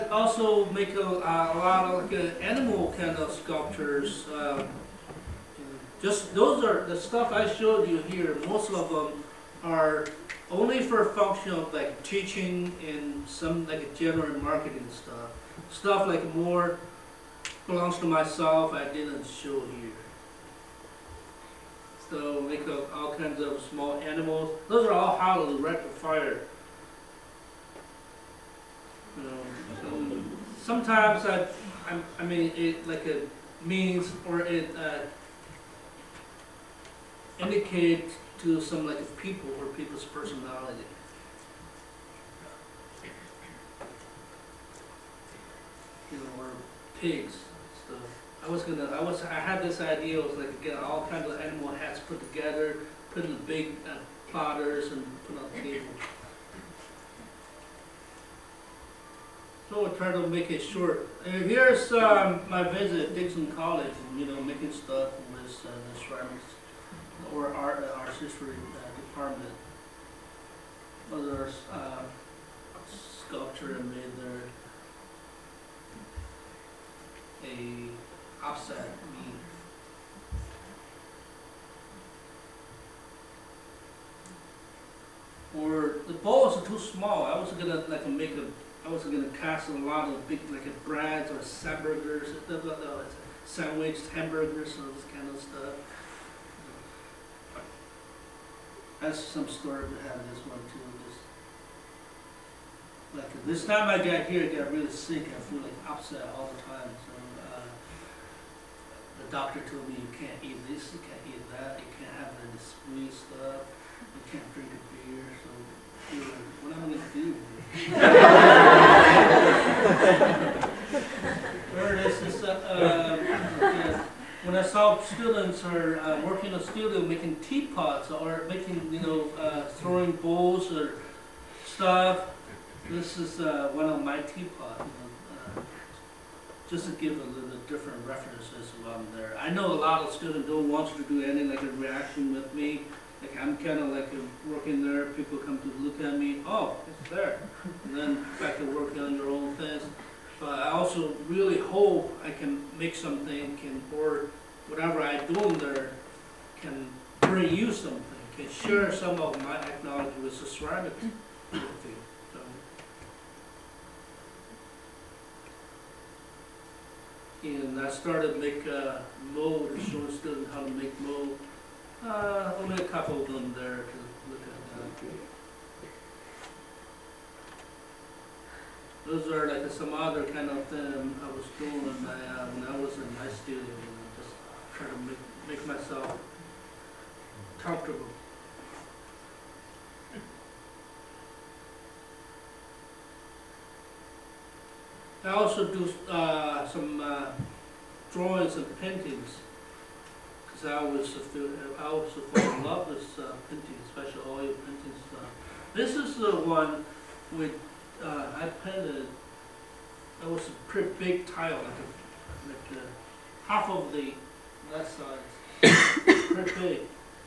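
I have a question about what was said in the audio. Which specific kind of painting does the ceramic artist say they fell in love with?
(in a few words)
oil paintings.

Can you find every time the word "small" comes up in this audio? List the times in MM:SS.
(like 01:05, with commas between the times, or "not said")
00:23, 01:26.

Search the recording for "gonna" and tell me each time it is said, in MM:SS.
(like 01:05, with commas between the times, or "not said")
00:48, 01:27, 01:58.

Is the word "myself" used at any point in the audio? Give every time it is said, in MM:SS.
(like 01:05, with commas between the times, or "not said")
00:18, 03:05.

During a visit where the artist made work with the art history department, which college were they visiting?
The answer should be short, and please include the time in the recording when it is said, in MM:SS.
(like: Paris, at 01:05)
Dickinson College, at 01:03.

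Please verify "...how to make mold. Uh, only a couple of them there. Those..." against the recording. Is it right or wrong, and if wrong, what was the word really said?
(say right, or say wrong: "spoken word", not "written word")
right.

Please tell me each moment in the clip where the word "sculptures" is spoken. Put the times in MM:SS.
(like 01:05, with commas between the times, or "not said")
00:03, 01:12.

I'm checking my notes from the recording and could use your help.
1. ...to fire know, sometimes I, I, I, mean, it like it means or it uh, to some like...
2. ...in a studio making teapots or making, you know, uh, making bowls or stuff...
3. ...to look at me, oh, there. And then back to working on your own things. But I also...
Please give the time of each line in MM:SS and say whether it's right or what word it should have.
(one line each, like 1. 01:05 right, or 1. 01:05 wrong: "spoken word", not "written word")
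1. 00:25 right
2. 02:06 wrong: "throwing", not "making"
3. 02:25 right.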